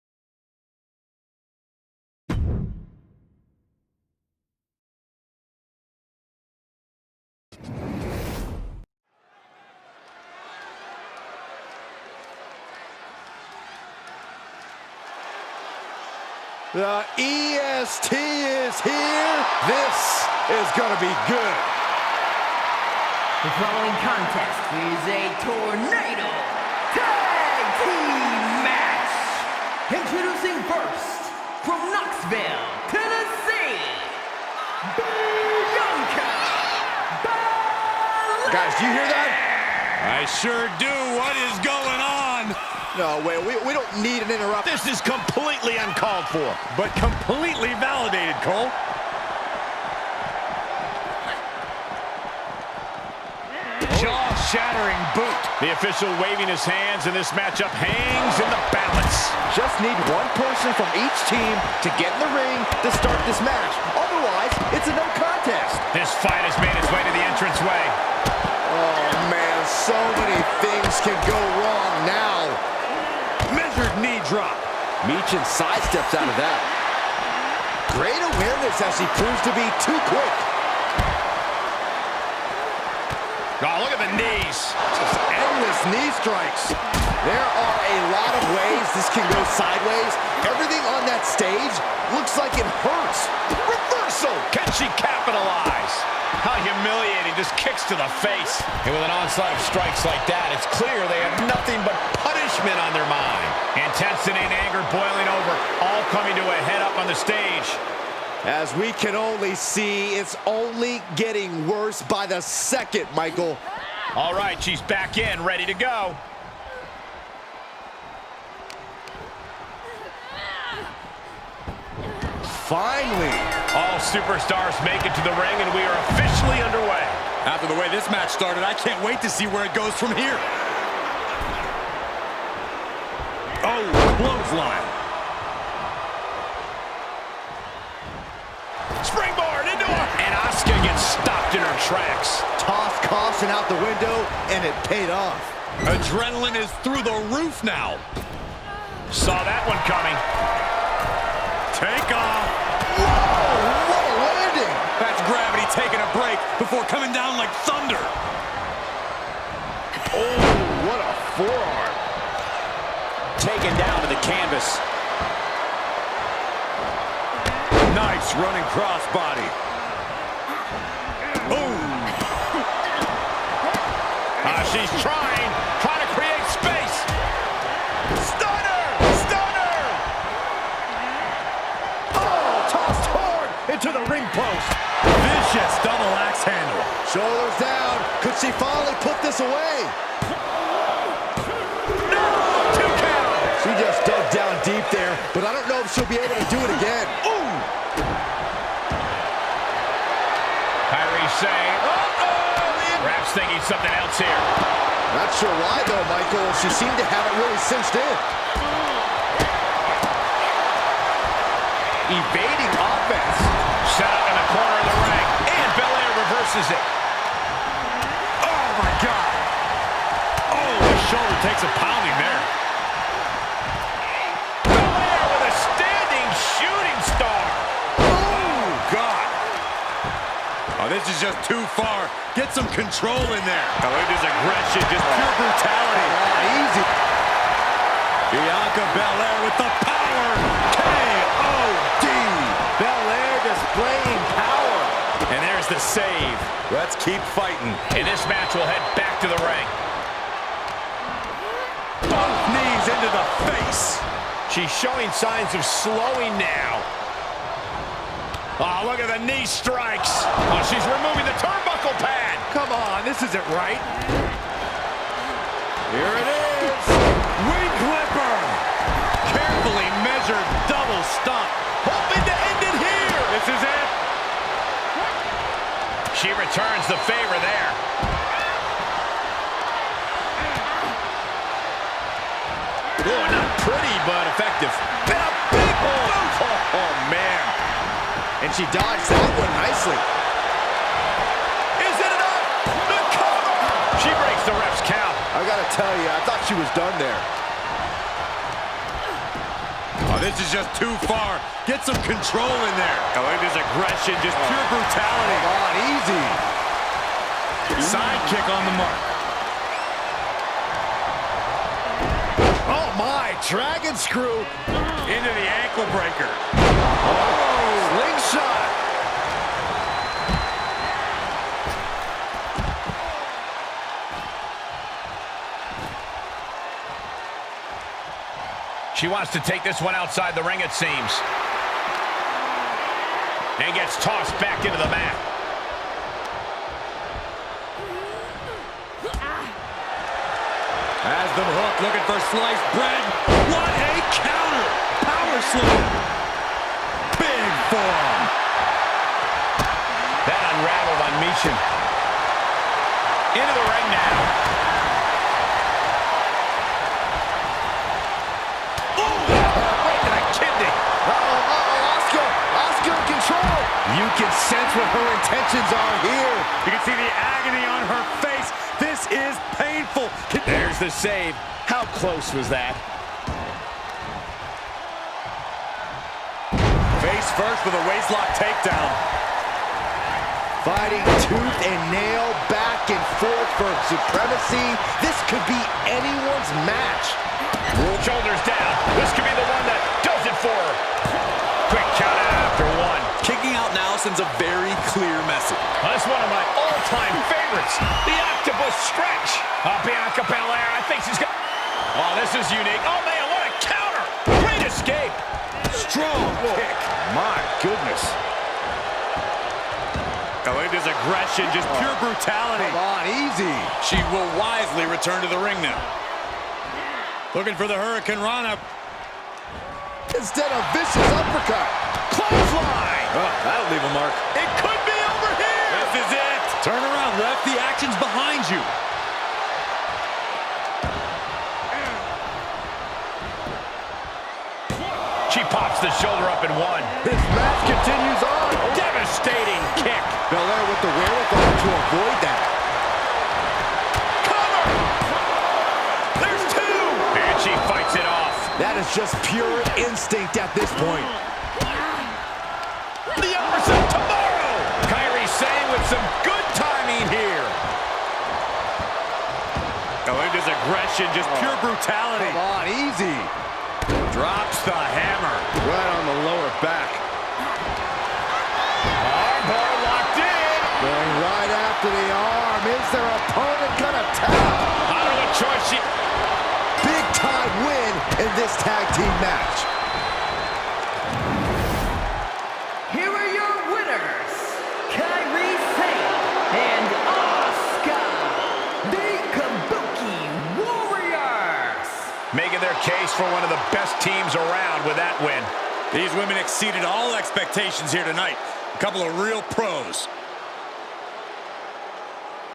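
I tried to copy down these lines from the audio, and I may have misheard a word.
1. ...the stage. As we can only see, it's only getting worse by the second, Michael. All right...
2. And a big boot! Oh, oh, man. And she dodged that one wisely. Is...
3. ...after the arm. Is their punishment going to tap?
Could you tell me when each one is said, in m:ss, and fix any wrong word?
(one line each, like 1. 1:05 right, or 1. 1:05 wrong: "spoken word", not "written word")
1. 1:47 right
2. 4:45 wrong: "nicely", not "wisely"
3. 7:51 wrong: "opponent", not "punishment".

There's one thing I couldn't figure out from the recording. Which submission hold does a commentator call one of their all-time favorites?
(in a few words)
Octopus stretch.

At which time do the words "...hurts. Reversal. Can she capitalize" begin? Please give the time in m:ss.
1:32.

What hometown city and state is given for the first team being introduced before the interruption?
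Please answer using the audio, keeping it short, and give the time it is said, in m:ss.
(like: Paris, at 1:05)
Knoxville, Tennessee, at 0:31.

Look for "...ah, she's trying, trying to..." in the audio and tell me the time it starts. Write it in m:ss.
2:54.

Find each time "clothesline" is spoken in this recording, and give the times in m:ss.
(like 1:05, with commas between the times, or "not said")
2:14, 7:02.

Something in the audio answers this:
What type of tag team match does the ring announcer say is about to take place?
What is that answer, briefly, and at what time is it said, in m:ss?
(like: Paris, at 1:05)
Tornado tag team match, at 0:25.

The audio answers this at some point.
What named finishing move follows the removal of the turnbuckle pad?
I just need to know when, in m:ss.
4:27.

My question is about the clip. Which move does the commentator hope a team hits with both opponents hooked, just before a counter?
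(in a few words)
Sliced bread.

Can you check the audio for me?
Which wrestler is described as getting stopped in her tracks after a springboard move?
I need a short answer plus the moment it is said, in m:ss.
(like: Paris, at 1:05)
Asuka, at 2:20.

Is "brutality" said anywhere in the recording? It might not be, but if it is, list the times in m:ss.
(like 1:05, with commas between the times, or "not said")
3:55, 5:04, 6:52, 7:41.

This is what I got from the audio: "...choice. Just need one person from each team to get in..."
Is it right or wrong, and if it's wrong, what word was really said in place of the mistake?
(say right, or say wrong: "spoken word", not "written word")
wrong: "balance", not "choice".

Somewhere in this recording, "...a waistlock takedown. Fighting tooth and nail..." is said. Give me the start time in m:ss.
6:17.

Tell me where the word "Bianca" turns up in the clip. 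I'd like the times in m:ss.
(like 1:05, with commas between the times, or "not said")
3:58, 6:39.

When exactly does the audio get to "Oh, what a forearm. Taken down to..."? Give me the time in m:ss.
2:40.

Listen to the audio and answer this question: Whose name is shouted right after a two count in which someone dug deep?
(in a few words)
Kairi Sane.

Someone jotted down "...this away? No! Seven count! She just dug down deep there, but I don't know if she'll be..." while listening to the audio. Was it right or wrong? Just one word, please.
wrong.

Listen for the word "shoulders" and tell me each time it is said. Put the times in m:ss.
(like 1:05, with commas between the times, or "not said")
3:07, 3:41, 6:28, 7:15.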